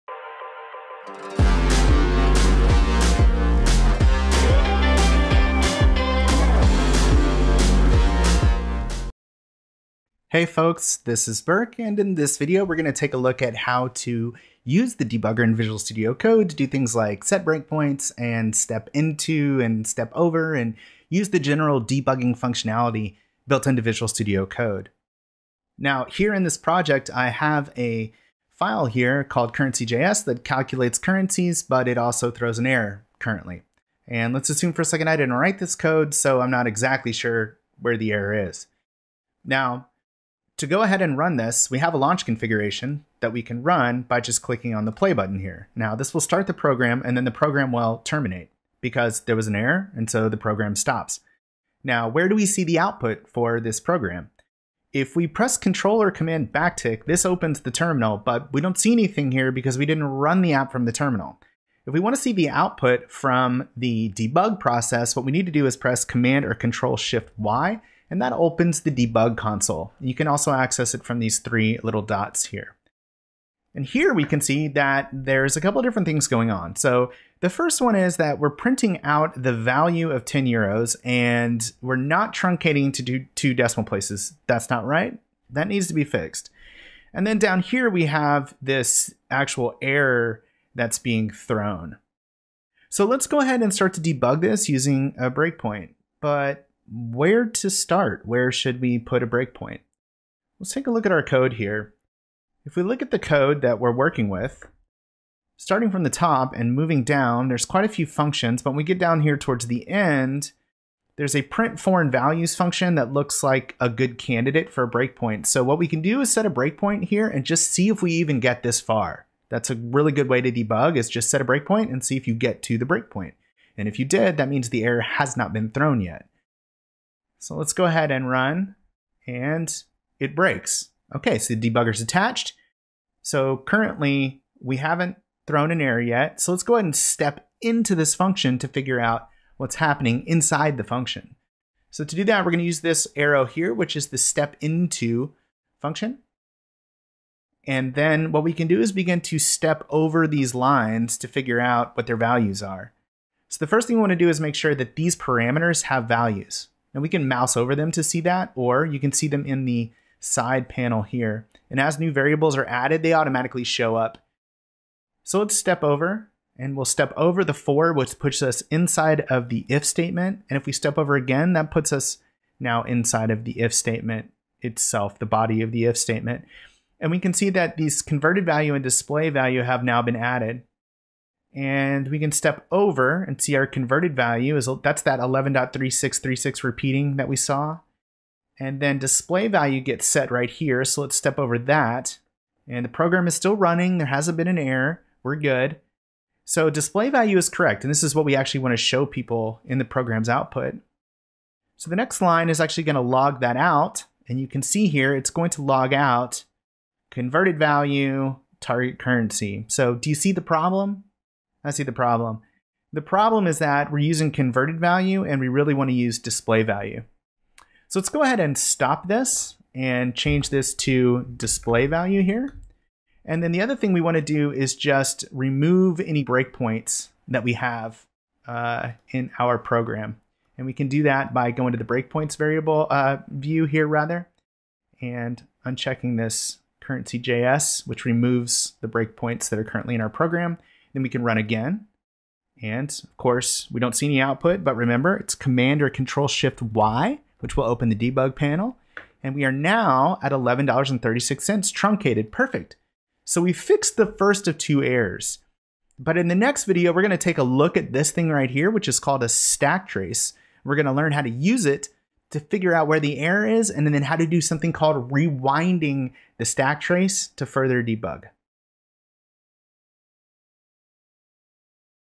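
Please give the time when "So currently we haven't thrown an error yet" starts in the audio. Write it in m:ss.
2:13.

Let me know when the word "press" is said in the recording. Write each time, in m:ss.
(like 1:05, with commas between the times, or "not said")
0:55, 1:05.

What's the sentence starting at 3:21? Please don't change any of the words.
So the next line is actually going to log that out.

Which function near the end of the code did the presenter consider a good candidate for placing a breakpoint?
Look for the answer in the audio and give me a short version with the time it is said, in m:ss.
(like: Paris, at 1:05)
print foreign values, at 1:51.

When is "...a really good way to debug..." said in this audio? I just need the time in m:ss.
1:59.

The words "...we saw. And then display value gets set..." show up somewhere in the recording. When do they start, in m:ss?
3:07.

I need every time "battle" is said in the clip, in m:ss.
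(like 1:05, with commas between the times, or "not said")
not said.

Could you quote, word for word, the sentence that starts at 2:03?
And if you did, that means the error has not been thrown yet.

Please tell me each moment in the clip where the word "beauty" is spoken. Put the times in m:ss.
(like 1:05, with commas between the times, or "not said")
not said.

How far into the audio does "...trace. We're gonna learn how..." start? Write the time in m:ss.
4:19.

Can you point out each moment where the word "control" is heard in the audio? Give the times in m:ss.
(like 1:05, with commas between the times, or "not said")
0:55, 1:06, 4:05.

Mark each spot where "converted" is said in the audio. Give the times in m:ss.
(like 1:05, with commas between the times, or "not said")
2:58, 3:03, 3:27, 3:34.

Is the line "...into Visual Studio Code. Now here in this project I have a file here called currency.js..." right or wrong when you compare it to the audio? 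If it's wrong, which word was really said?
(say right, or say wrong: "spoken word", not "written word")
right.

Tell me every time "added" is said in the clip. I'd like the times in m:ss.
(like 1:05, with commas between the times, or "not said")
2:42, 3:00.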